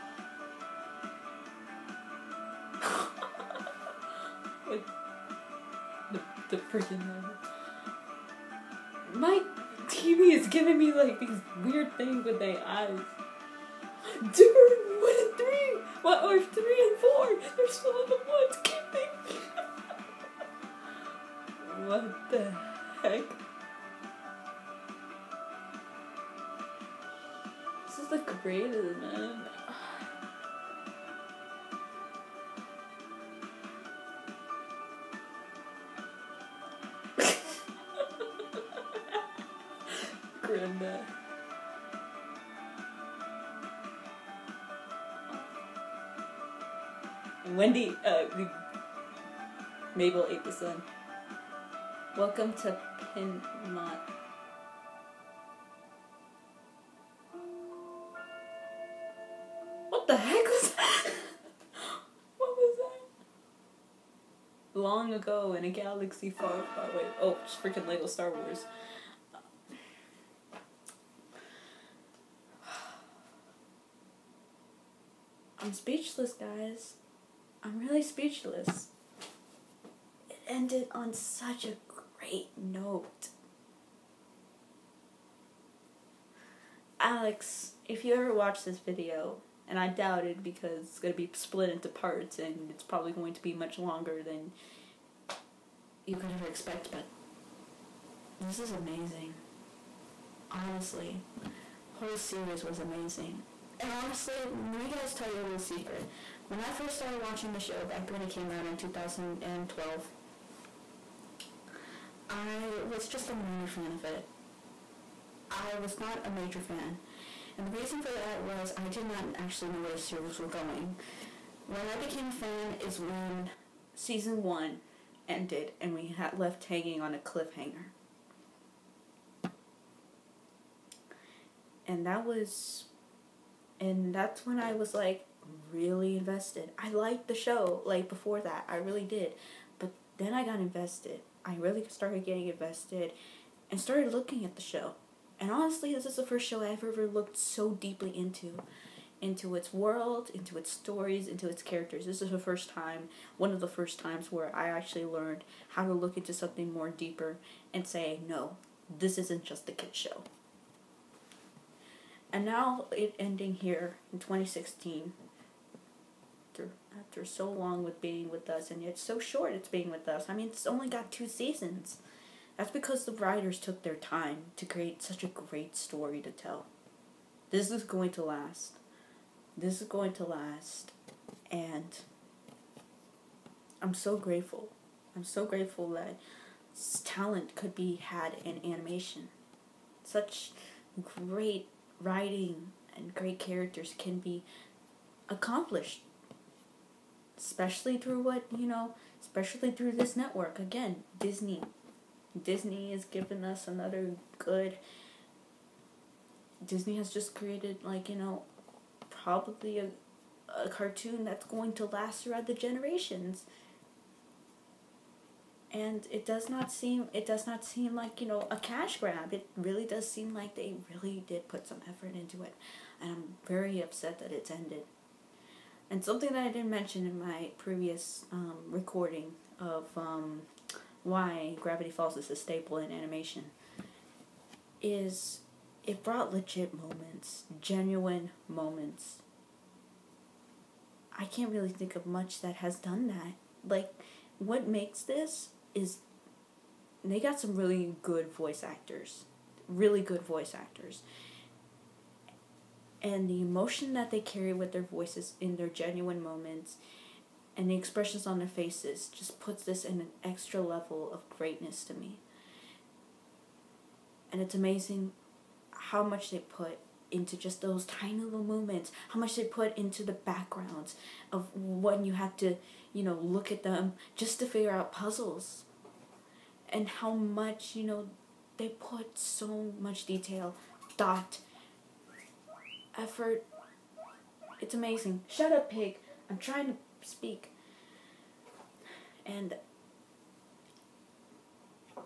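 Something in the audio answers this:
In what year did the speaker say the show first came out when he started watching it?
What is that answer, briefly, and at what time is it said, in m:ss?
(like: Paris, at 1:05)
2012, at 1:48.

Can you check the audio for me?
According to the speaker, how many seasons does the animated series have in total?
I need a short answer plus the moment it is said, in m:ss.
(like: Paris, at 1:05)
2, at 2:51.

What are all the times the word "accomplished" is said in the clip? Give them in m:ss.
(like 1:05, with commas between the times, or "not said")
3:15.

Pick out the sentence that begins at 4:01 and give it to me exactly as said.
I can't really think of much that has done that.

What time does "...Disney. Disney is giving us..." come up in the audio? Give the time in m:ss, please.
3:21.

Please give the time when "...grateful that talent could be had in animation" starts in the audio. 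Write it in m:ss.
3:05.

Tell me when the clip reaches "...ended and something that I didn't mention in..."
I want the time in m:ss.
3:44.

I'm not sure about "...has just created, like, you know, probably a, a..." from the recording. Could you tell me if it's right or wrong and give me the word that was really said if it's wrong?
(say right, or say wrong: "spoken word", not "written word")
right.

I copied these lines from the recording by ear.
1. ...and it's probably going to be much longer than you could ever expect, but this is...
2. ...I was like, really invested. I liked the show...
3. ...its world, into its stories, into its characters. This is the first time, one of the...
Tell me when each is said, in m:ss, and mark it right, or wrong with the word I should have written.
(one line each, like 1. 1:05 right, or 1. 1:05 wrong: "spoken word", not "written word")
1. 1:32 right
2. 2:14 right
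3. 2:29 right.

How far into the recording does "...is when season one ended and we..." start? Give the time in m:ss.
2:02.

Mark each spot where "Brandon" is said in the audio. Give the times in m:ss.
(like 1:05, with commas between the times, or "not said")
not said.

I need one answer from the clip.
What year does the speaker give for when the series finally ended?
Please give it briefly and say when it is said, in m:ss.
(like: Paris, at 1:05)
2016, at 2:44.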